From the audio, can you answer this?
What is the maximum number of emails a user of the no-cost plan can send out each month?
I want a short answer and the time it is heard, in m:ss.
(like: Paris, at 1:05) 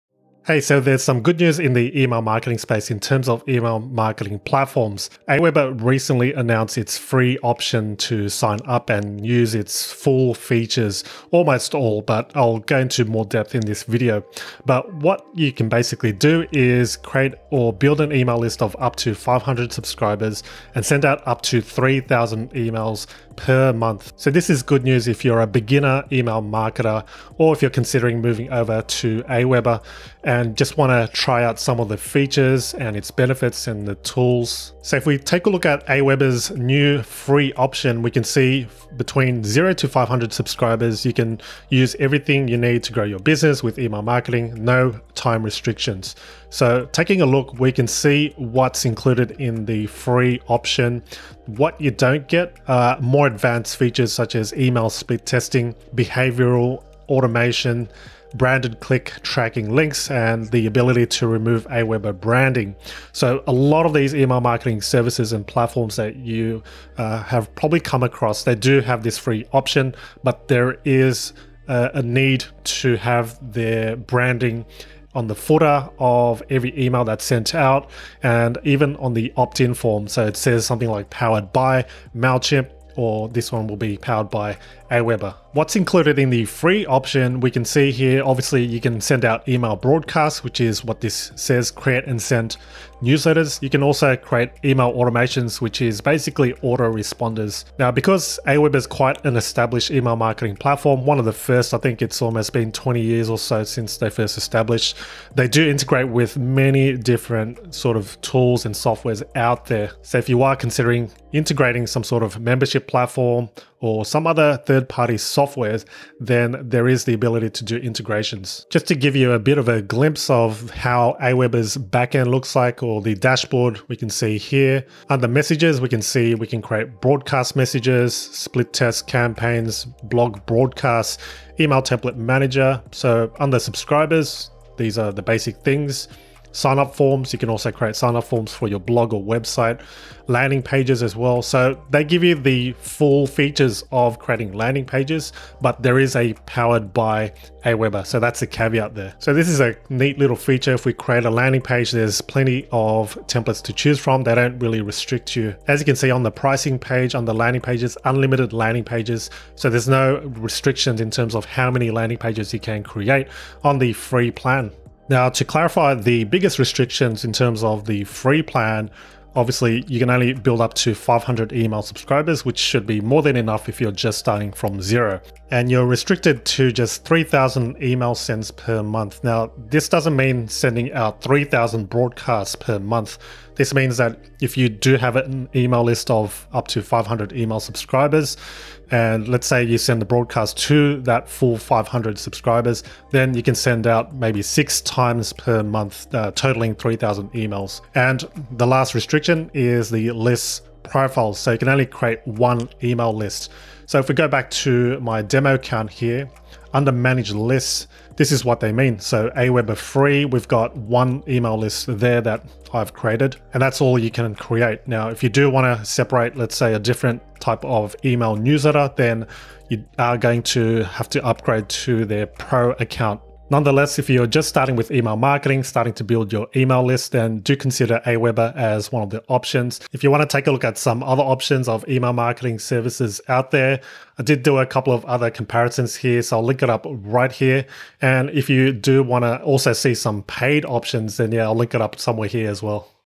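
3,000, at 0:21.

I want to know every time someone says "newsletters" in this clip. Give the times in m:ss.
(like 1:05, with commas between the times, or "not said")
1:33, 3:38.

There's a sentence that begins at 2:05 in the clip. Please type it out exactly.
Under messages, we can see we can create broadcast messages, split test campaigns, blog broadcasts, email template manager.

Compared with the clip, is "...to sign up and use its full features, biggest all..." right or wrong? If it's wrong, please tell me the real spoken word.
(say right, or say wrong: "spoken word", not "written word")
wrong: "almost", not "biggest".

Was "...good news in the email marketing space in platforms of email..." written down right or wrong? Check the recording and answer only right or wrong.
wrong.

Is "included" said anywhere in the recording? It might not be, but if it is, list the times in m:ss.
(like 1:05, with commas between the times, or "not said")
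0:48, 1:25.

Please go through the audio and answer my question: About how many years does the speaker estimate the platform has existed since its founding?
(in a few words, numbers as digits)
20 years.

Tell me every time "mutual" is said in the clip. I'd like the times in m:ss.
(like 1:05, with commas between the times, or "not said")
not said.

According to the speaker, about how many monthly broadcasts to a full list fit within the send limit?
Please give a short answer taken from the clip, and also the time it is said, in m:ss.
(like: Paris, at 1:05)
6, at 3:14.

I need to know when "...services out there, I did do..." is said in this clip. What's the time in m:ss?
3:52.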